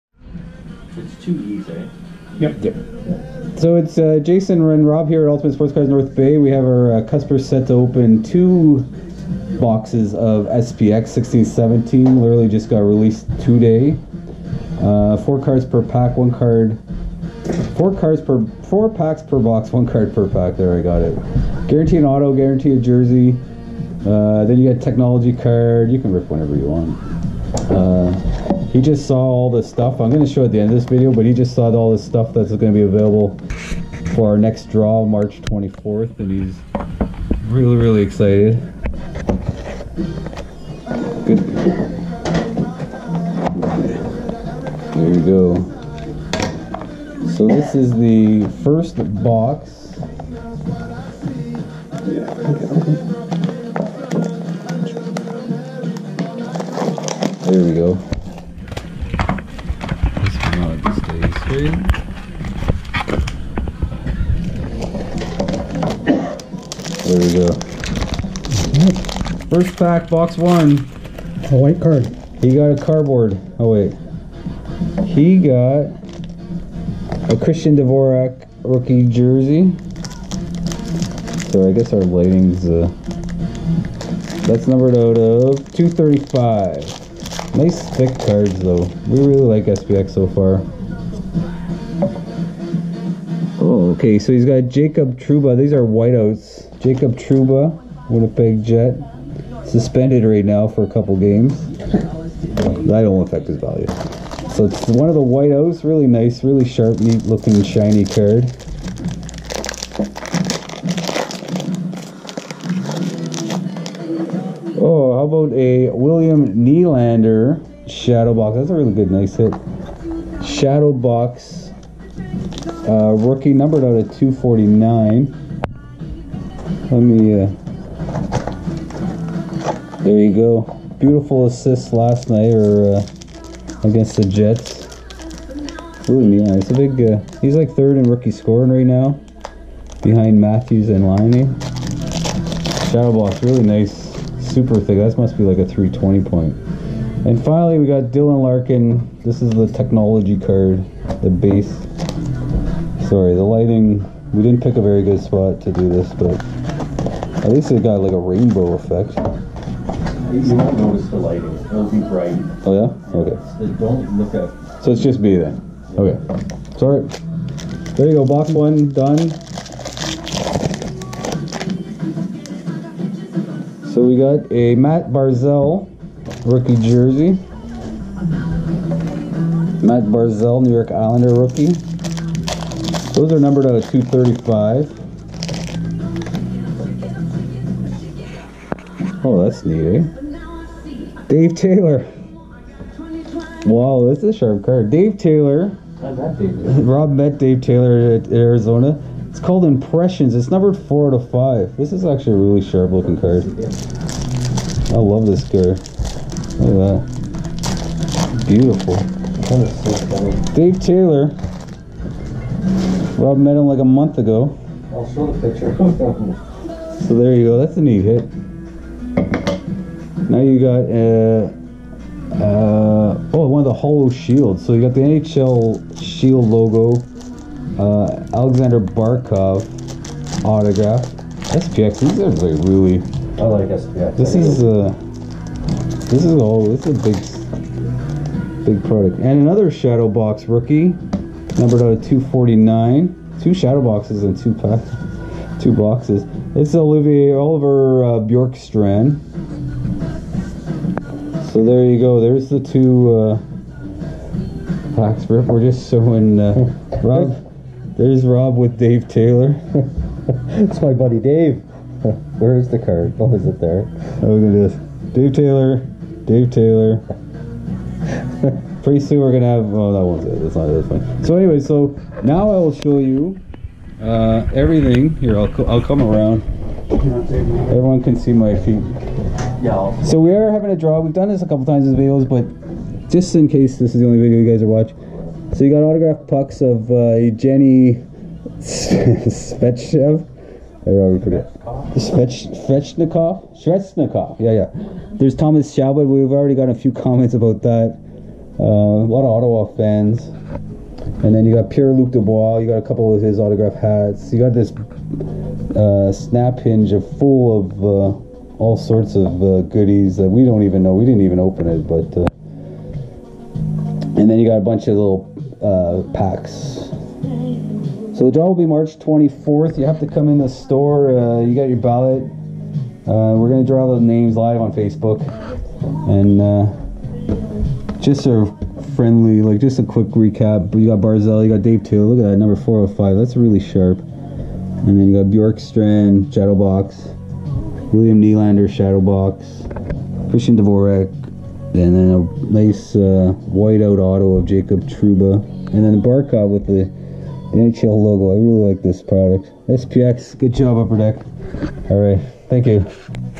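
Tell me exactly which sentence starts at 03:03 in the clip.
Those are numbered out of 235.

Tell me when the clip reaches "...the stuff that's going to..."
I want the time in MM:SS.
00:31.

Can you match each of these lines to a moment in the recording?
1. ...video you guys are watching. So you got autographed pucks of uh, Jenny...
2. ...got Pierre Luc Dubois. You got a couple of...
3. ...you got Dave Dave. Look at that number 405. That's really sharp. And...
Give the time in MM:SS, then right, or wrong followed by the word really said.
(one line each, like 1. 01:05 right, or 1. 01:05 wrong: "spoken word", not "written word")
1. 04:44 right
2. 05:01 right
3. 05:31 wrong: "Taylor", not "Dave".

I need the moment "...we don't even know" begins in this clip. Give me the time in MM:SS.
05:10.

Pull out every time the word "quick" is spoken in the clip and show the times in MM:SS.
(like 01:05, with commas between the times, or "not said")
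05:29.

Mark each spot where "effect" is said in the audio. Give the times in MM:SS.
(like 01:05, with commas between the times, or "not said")
02:38.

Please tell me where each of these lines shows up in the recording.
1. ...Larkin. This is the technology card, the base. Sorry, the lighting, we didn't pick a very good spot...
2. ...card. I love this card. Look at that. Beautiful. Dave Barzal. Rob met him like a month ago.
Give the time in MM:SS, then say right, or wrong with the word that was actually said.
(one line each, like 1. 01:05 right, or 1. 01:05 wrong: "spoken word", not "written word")
1. 02:28 right
2. 03:23 wrong: "Taylor", not "Barzal".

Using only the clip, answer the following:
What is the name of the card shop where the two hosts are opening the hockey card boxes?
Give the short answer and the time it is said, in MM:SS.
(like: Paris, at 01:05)
Ultimate Sportscards North Bay, at 00:05.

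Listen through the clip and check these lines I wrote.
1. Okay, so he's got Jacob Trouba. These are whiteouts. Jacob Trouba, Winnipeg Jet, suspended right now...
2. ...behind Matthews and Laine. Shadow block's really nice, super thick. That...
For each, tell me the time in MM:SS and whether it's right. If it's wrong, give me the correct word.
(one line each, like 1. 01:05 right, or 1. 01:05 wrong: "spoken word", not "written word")
1. 01:34 right
2. 02:20 right.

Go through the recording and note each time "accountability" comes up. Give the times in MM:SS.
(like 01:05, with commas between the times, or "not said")
not said.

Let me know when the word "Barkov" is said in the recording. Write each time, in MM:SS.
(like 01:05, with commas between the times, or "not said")
03:48, 05:46.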